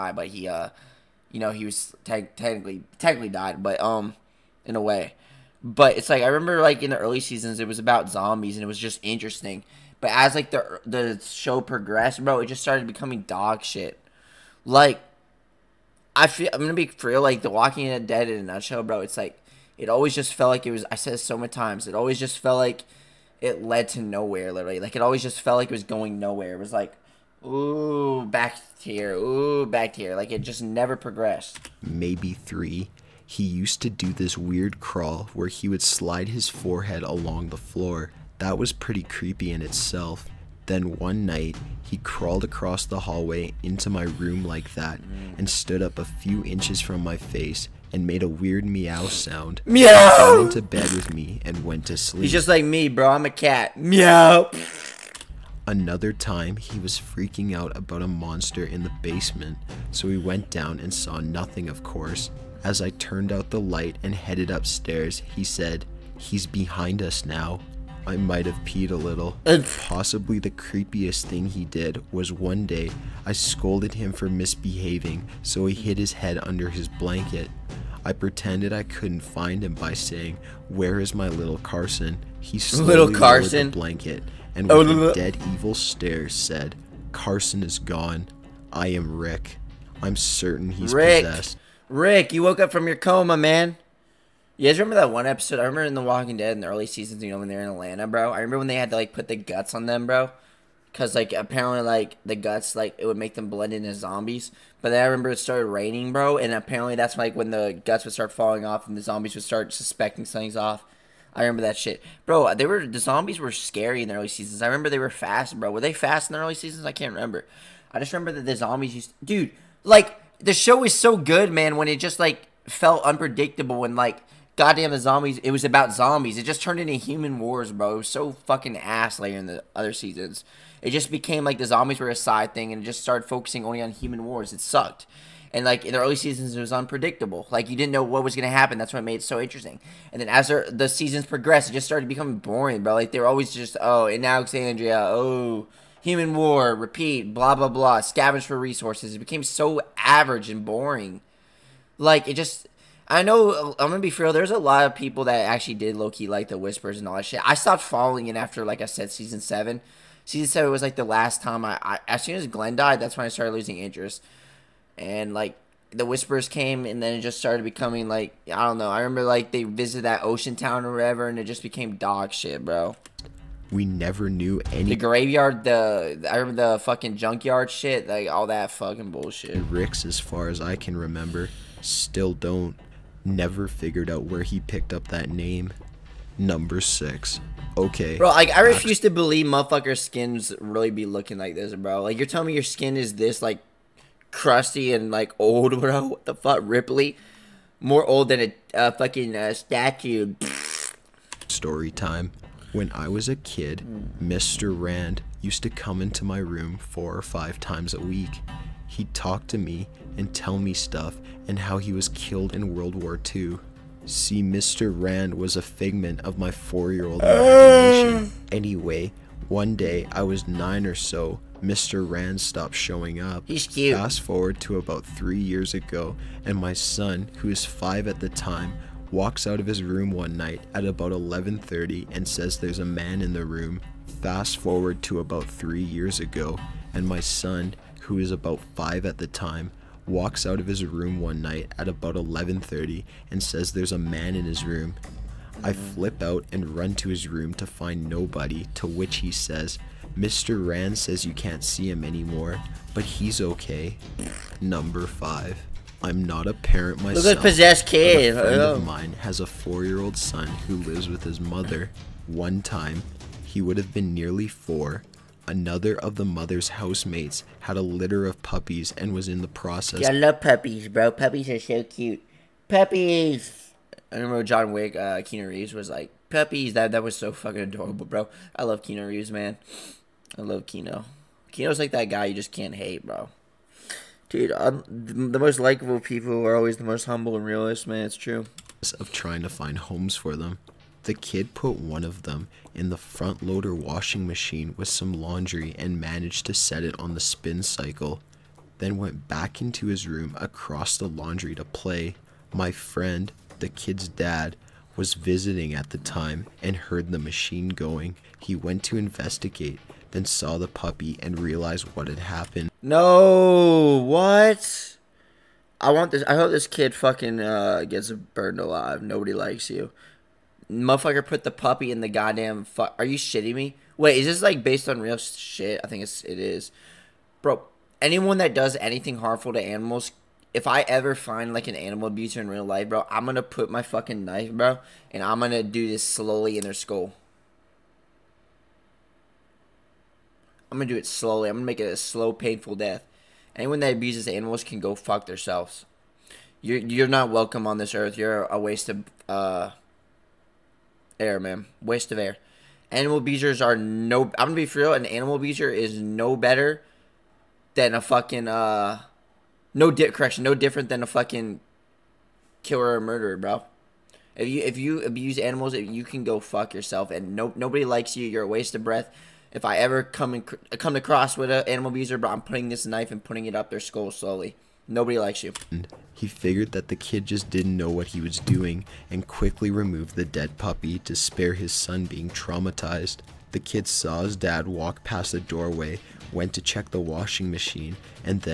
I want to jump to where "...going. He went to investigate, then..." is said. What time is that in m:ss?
5:07.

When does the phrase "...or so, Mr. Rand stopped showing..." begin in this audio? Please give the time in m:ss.
3:40.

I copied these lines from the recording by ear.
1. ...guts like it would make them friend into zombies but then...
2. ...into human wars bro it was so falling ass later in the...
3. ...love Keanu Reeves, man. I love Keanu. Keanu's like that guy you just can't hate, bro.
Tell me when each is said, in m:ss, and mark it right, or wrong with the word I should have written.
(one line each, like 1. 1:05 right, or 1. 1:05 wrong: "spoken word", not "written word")
1. 1:42 wrong: "blend", not "friend"
2. 2:06 wrong: "fucking", not "falling"
3. 4:38 right.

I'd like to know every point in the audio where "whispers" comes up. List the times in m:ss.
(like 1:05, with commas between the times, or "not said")
2:36, 2:46.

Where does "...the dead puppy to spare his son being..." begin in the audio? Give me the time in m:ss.
6:20.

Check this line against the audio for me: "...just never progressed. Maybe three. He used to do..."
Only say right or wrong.
right.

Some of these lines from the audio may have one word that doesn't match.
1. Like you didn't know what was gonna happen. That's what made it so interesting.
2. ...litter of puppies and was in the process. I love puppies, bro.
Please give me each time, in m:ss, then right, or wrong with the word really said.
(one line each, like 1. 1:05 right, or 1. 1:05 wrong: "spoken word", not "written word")
1. 2:17 right
2. 4:27 right.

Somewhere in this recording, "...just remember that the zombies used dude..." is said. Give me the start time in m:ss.
1:57.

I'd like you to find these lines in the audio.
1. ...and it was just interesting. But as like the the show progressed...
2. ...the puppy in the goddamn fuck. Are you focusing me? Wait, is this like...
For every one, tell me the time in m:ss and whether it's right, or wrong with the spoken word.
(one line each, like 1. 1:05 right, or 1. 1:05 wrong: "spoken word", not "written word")
1. 0:08 right
2. 5:21 wrong: "shitting", not "focusing".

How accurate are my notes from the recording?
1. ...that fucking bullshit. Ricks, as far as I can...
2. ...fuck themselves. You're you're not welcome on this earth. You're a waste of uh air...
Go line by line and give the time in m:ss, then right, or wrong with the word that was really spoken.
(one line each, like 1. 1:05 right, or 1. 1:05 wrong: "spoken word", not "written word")
1. 2:58 right
2. 5:44 right.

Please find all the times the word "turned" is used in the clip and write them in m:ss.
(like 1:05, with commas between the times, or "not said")
1:02, 2:06.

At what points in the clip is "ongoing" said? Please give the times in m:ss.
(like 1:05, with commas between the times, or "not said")
not said.